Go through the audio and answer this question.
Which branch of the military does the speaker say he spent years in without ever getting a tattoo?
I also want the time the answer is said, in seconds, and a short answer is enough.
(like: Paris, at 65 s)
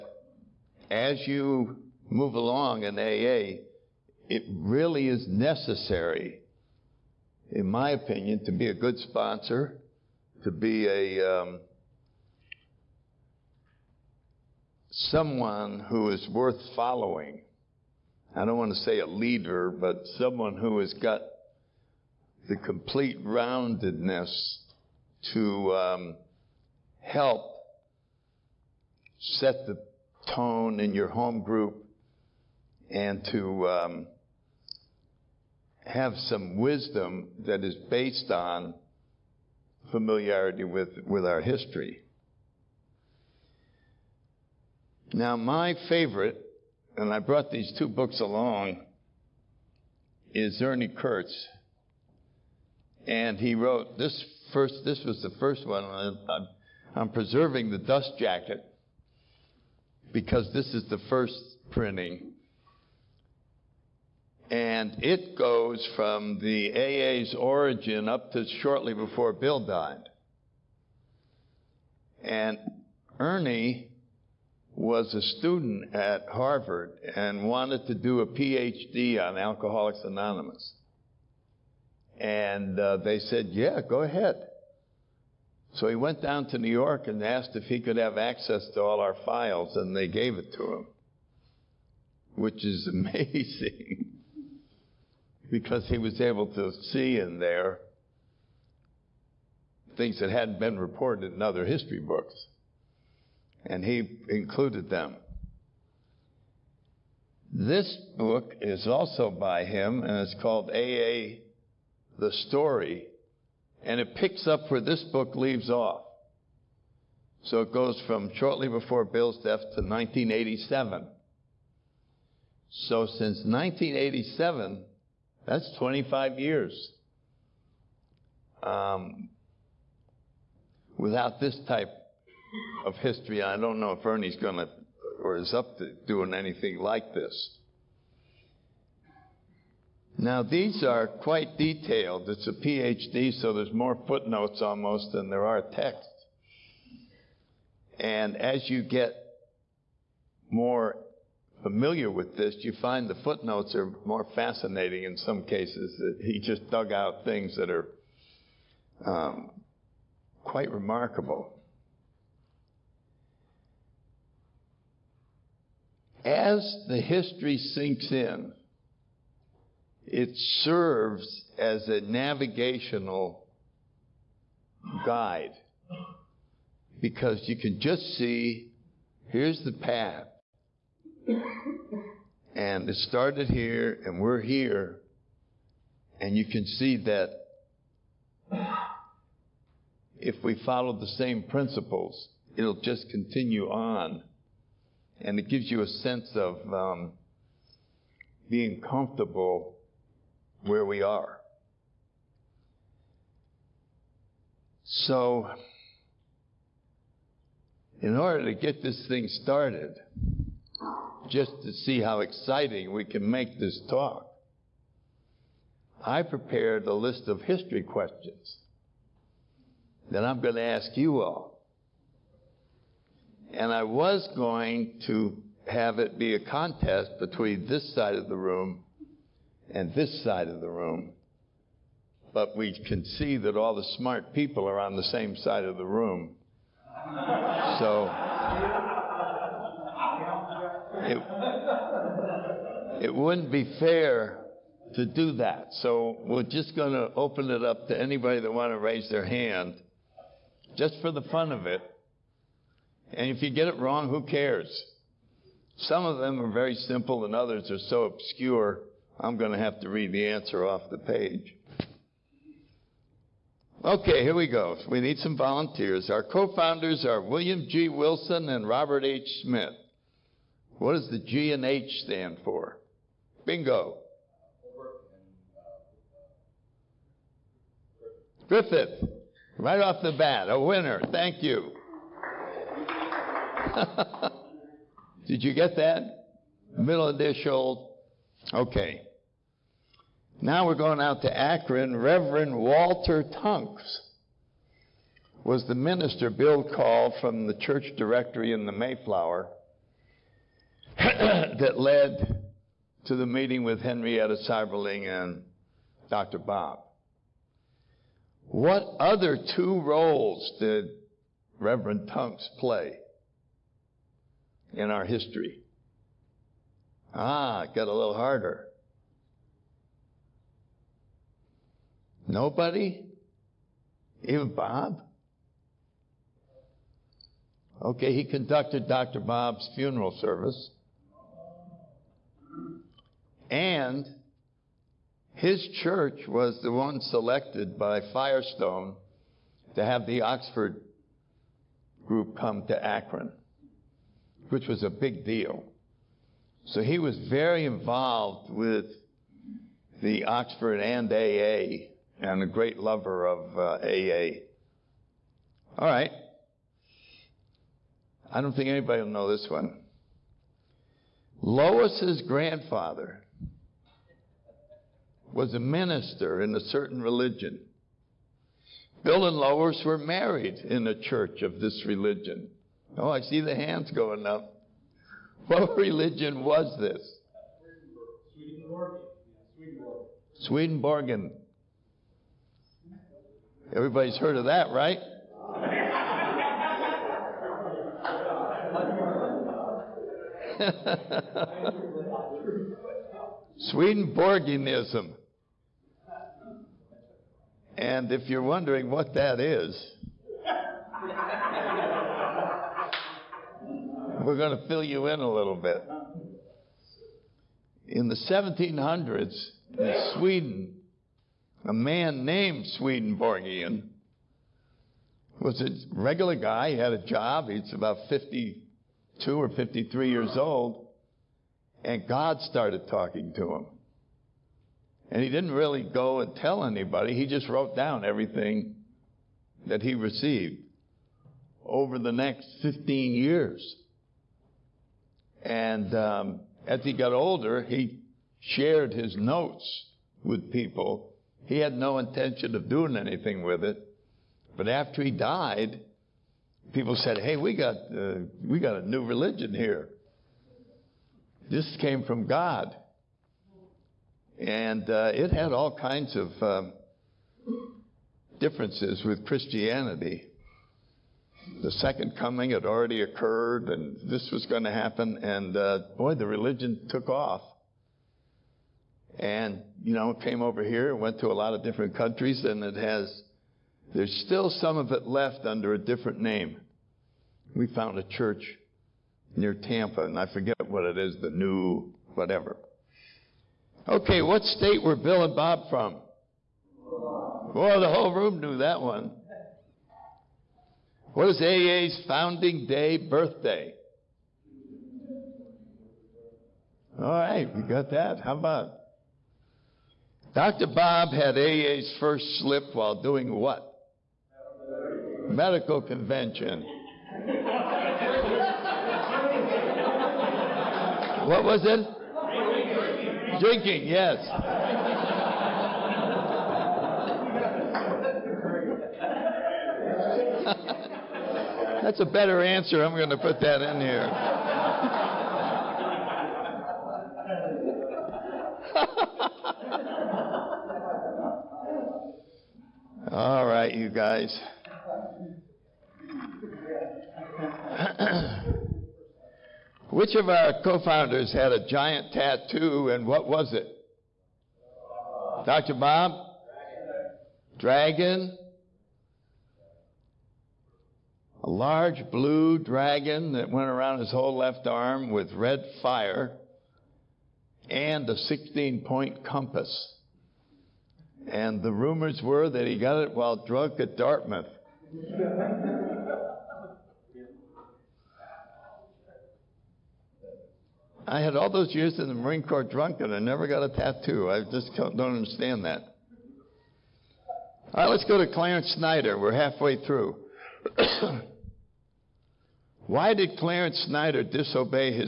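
Marine Corps, at 572 s.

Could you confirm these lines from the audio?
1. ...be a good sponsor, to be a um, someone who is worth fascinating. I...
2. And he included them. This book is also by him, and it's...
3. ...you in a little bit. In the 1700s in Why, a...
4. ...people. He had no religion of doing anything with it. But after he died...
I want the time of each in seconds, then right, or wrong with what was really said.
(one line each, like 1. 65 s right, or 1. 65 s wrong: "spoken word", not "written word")
1. 8 s wrong: "following", not "fascinating"
2. 103 s right
3. 404 s wrong: "Sweden", not "Why"
4. 440 s wrong: "intention", not "religion".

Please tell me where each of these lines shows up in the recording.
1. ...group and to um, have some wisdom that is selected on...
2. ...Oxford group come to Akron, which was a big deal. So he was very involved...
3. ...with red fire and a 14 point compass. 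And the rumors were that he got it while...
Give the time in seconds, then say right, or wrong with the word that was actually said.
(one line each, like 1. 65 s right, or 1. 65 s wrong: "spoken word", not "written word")
1. 31 s wrong: "based", not "selected"
2. 340 s right
3. 555 s wrong: "16", not "14".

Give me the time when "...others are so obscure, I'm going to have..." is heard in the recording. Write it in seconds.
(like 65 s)
257 s.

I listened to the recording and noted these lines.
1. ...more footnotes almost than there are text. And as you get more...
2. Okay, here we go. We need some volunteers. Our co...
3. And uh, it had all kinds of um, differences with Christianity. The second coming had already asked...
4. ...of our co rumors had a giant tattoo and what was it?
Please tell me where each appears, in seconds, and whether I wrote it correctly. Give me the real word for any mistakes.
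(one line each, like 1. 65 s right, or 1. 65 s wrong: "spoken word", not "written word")
1. 143 s right
2. 263 s right
3. 454 s wrong: "occurred", not "asked"
4. 540 s wrong: "founders", not "rumors".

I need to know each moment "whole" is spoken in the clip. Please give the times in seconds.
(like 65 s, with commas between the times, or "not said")
487 s, 554 s.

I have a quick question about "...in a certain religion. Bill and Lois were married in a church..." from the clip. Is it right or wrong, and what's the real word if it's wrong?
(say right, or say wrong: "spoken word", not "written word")
right.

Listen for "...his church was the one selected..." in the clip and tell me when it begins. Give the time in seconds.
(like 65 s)
335 s.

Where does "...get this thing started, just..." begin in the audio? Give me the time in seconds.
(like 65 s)
208 s.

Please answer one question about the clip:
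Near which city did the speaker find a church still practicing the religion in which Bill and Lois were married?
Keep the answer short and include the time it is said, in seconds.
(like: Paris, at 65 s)
Tampa, at 479 s.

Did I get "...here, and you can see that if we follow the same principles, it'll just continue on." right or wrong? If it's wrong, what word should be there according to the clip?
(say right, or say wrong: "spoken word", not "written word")
right.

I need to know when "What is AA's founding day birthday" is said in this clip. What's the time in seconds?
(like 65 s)
491 s.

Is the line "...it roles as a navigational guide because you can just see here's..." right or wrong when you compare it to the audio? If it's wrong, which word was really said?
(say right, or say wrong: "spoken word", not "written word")
wrong: "serves", not "roles".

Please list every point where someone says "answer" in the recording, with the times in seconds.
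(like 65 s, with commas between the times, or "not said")
260 s, 522 s.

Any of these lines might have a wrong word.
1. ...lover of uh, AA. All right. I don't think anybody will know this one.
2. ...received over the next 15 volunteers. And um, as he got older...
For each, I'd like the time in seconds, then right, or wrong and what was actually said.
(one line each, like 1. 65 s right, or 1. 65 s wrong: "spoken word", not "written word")
1. 352 s right
2. 429 s wrong: "years", not "volunteers".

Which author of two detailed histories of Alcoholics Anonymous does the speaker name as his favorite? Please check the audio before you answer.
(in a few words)
Ernie Kurtz.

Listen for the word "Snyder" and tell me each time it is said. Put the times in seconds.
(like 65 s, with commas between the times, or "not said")
578 s, 583 s.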